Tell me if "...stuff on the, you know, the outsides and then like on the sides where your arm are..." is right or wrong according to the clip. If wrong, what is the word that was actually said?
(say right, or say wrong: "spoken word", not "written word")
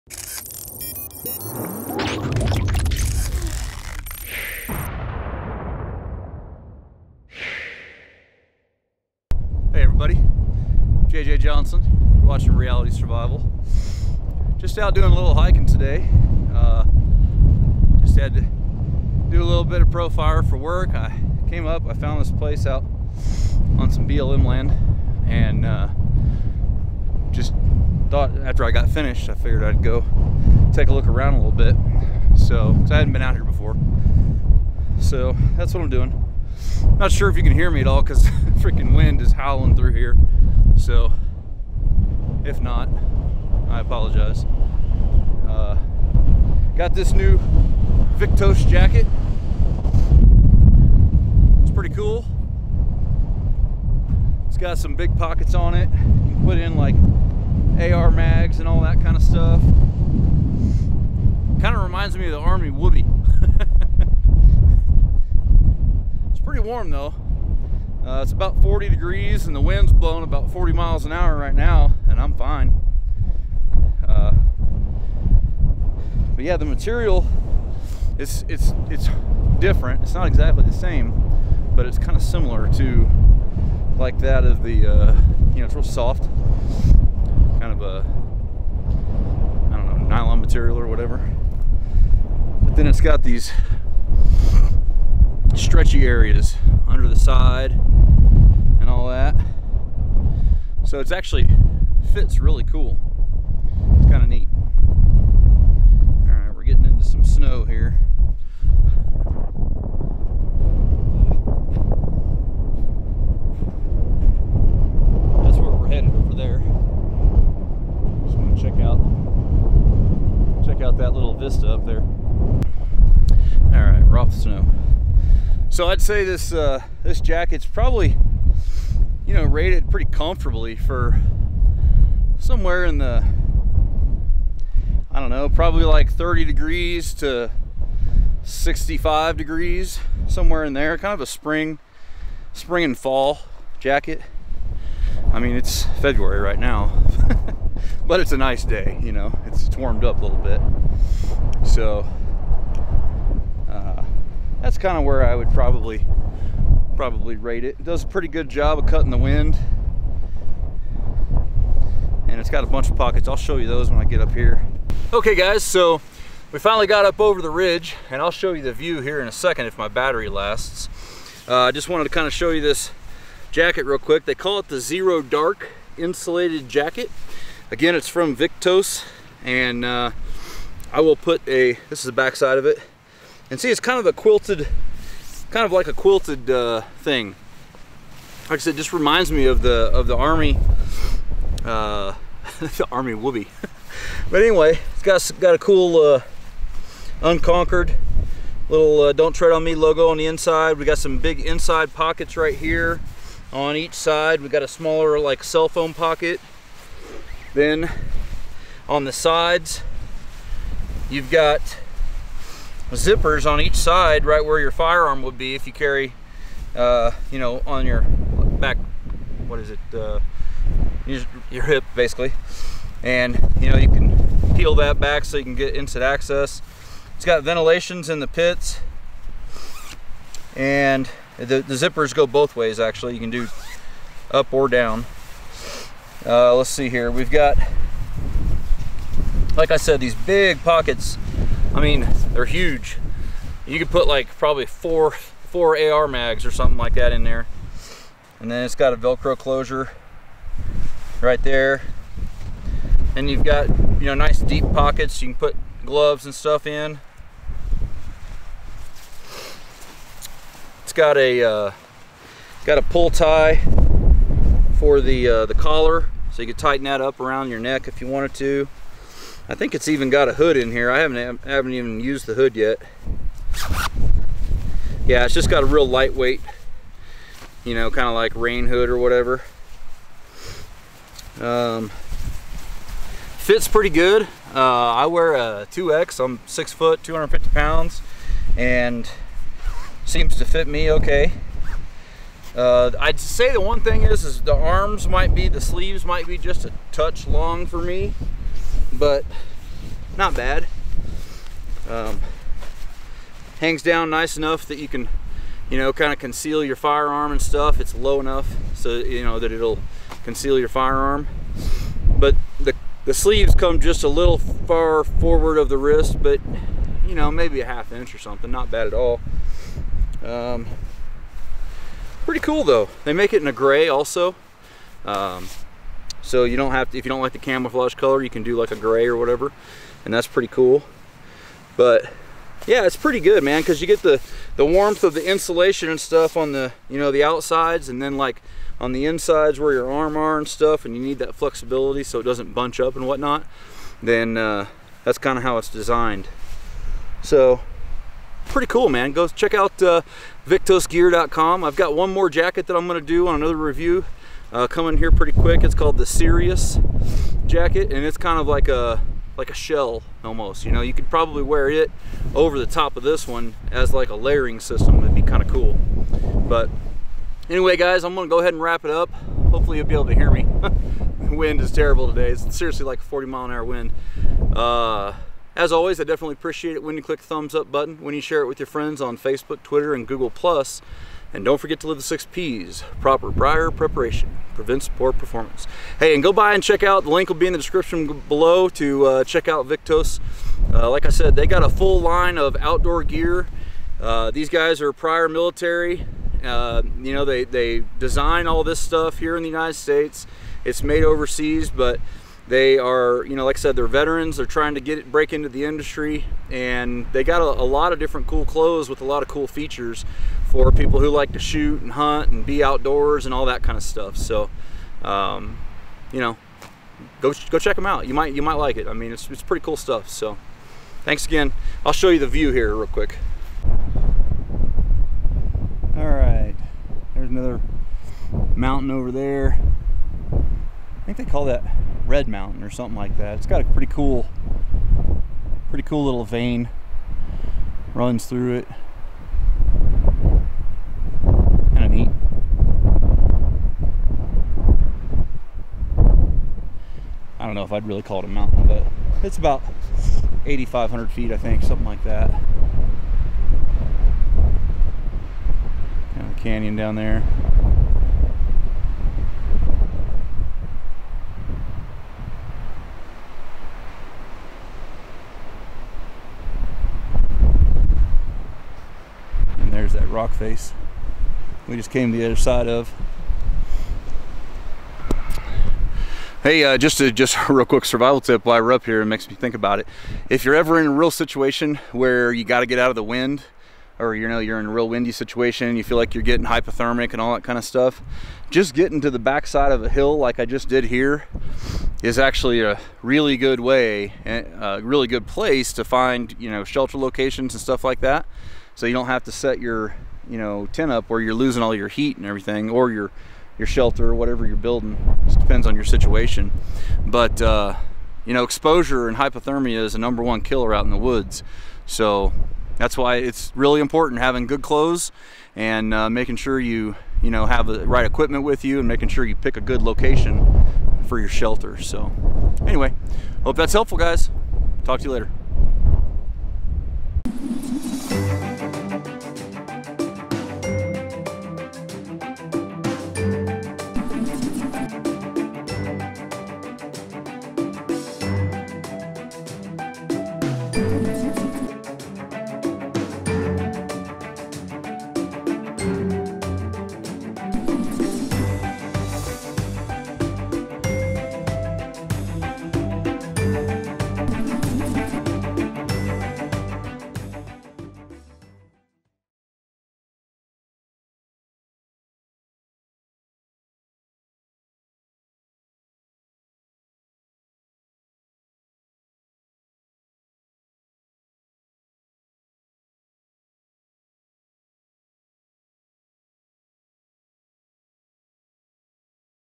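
wrong: "insides", not "sides".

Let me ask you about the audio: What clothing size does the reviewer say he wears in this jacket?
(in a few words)
2X.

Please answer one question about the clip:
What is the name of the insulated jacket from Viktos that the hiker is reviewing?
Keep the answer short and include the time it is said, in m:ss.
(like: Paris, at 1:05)
Zero Dark Insulated Jacket, at 2:54.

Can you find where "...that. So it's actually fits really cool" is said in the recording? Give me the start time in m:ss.
1:39.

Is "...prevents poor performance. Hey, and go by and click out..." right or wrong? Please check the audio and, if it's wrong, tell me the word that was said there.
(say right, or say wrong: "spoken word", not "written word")
wrong: "check", not "click".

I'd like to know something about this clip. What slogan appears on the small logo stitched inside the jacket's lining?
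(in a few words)
Don't Tread on Me.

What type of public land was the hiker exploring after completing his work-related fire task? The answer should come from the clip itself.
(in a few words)
BLM land.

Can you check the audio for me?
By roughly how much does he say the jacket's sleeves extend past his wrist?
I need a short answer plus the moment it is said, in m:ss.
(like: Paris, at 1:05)
half inch, at 5:17.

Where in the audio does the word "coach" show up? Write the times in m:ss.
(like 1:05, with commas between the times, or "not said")
not said.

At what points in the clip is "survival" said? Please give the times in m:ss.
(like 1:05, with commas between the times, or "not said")
0:12, 7:57.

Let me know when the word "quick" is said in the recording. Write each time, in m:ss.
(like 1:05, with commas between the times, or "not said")
2:53, 5:55, 7:02, 7:57.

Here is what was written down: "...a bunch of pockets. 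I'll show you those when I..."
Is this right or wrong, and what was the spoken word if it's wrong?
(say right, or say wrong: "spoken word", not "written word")
right.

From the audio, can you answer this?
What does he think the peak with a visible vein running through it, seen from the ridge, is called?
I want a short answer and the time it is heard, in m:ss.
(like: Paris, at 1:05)
Red Mountain, at 7:12.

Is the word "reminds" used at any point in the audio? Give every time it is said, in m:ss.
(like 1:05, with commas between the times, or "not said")
1:01, 3:08.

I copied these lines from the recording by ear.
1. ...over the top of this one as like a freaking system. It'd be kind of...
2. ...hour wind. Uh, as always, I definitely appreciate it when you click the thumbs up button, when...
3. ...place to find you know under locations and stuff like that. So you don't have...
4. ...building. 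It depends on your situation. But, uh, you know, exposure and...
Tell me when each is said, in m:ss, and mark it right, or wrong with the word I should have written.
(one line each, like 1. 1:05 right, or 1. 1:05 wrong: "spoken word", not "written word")
1. 6:02 wrong: "layering", not "freaking"
2. 6:13 right
3. 8:15 wrong: "shelter", not "under"
4. 8:24 right.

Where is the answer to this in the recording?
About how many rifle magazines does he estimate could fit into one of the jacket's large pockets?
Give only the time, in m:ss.
4:05.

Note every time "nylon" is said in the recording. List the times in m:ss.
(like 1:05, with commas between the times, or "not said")
1:30.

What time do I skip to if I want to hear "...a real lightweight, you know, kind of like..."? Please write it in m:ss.
4:35.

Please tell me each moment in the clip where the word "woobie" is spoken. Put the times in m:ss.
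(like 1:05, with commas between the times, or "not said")
1:02, 3:13.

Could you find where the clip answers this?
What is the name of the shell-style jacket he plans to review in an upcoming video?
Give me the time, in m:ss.
5:56.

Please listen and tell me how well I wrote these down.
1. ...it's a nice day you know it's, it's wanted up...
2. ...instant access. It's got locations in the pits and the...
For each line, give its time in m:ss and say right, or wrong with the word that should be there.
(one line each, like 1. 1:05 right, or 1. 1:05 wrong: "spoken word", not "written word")
1. 2:28 wrong: "warmed", not "wanted"
2. 3:45 wrong: "ventilations", not "locations".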